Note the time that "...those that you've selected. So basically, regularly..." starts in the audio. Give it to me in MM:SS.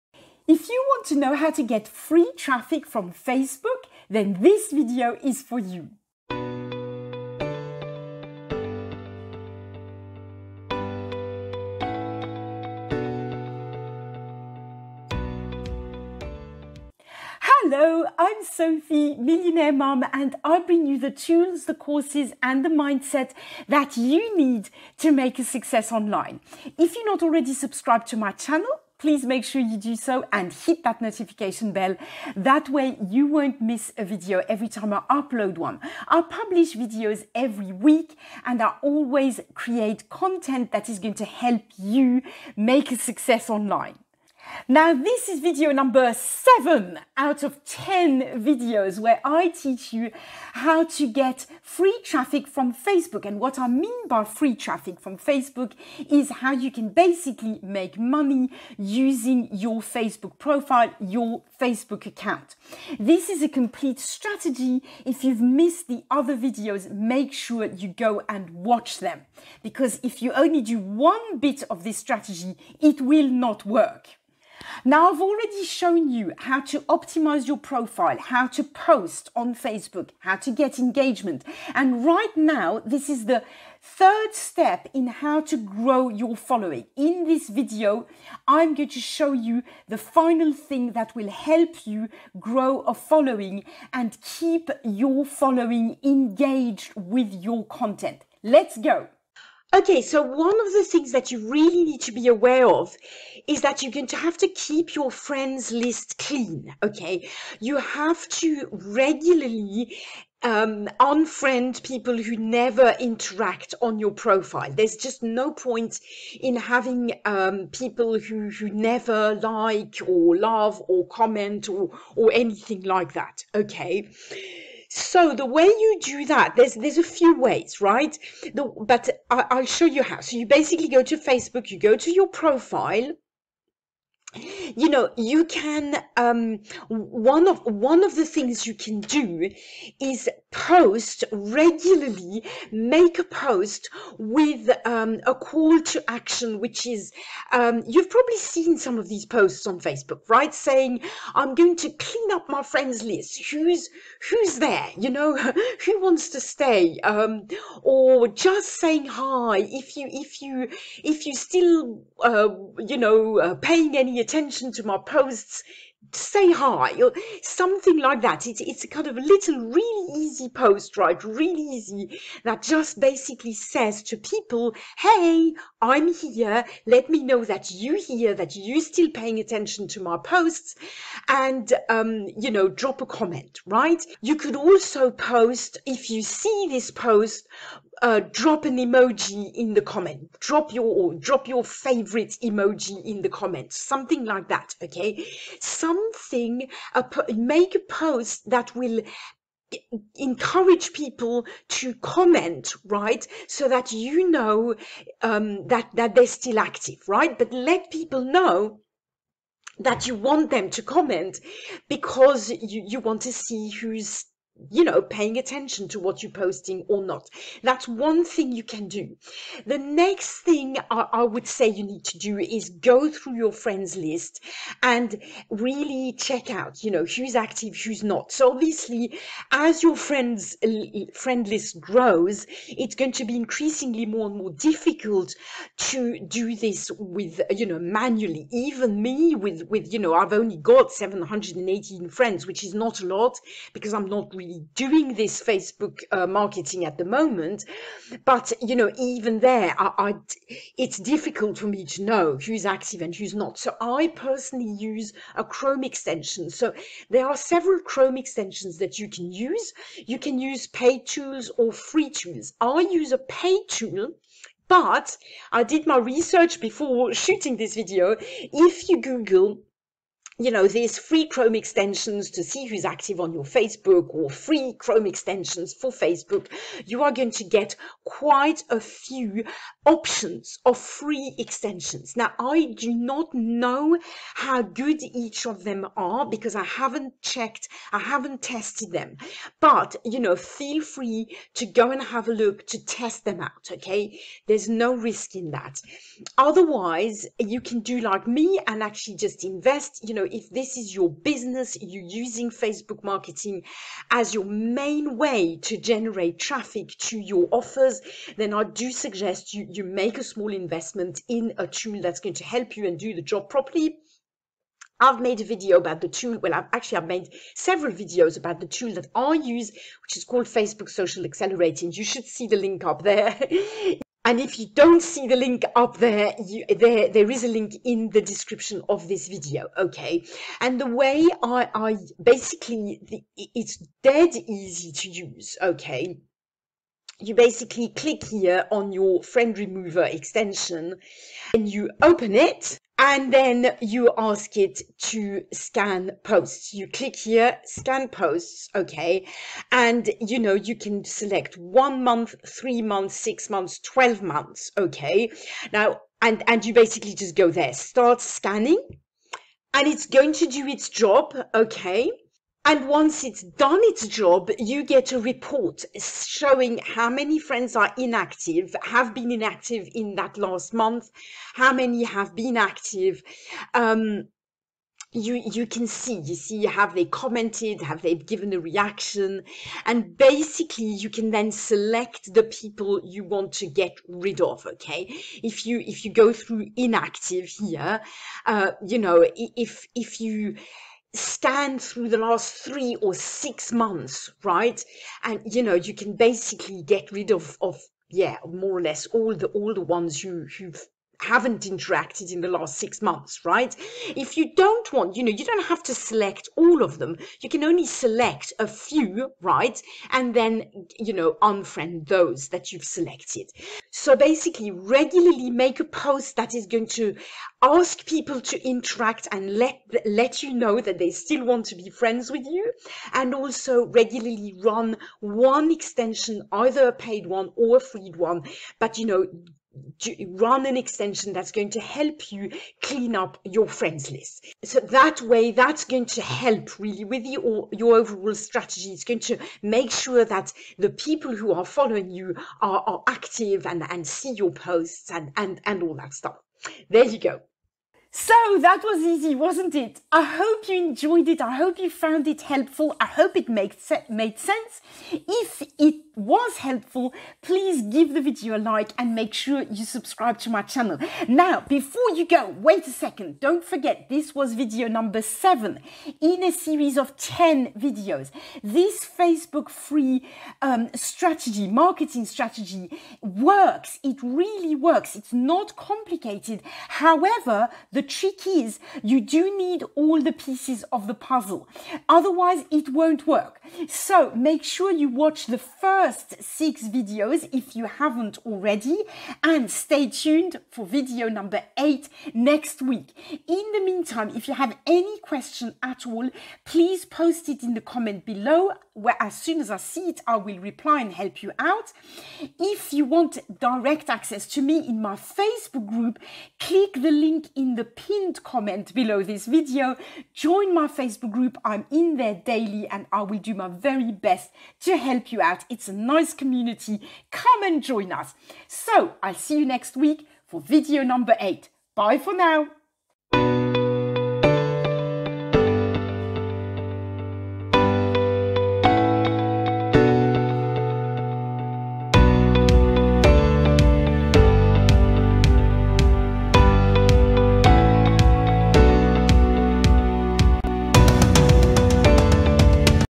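06:52.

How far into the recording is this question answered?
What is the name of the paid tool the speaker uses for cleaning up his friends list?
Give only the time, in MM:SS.
05:20.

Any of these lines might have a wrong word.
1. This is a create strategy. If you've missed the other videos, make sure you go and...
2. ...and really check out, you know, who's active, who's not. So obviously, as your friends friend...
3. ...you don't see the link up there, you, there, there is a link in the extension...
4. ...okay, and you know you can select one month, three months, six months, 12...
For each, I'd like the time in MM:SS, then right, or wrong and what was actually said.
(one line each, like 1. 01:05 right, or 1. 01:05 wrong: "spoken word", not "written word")
1. 01:02 wrong: "complete", not "create"
2. 03:44 right
3. 05:24 wrong: "description", not "extension"
4. 05:48 right.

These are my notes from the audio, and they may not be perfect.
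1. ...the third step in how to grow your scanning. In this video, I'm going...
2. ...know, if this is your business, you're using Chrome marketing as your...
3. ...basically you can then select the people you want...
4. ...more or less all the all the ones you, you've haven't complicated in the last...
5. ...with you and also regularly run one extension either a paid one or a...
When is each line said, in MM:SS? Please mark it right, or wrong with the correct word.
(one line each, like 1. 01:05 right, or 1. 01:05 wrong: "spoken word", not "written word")
1. 01:23 wrong: "following", not "scanning"
2. 05:00 wrong: "Facebook", not "Chrome"
3. 06:20 right
4. 06:38 wrong: "interacted", not "complicated"
5. 07:02 right.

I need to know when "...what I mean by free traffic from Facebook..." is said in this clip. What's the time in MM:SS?
00:53.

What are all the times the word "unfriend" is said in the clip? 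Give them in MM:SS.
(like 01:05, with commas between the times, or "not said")
01:50, 06:51.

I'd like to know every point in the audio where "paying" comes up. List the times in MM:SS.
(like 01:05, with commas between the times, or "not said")
02:43, 02:59, 03:35.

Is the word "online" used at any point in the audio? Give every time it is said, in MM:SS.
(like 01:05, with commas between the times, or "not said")
00:43.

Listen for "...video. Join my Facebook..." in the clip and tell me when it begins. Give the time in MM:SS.
08:29.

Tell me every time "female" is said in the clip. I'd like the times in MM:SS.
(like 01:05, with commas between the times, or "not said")
not said.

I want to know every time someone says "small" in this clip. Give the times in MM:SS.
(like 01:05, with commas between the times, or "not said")
05:10.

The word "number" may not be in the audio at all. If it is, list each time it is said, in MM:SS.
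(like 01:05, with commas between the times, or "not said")
00:45, 07:44, 08:11, 08:41.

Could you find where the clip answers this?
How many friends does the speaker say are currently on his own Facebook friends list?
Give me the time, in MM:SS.
04:00.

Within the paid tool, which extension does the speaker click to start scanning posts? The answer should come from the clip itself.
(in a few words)
friend remover.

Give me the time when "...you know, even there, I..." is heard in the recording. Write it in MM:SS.
04:08.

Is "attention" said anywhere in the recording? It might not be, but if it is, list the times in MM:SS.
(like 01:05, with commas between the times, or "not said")
02:44, 02:59, 03:35.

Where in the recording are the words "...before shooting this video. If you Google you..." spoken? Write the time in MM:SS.
04:26.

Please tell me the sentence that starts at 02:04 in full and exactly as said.
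So the way you do that, there's there's a few ways, right?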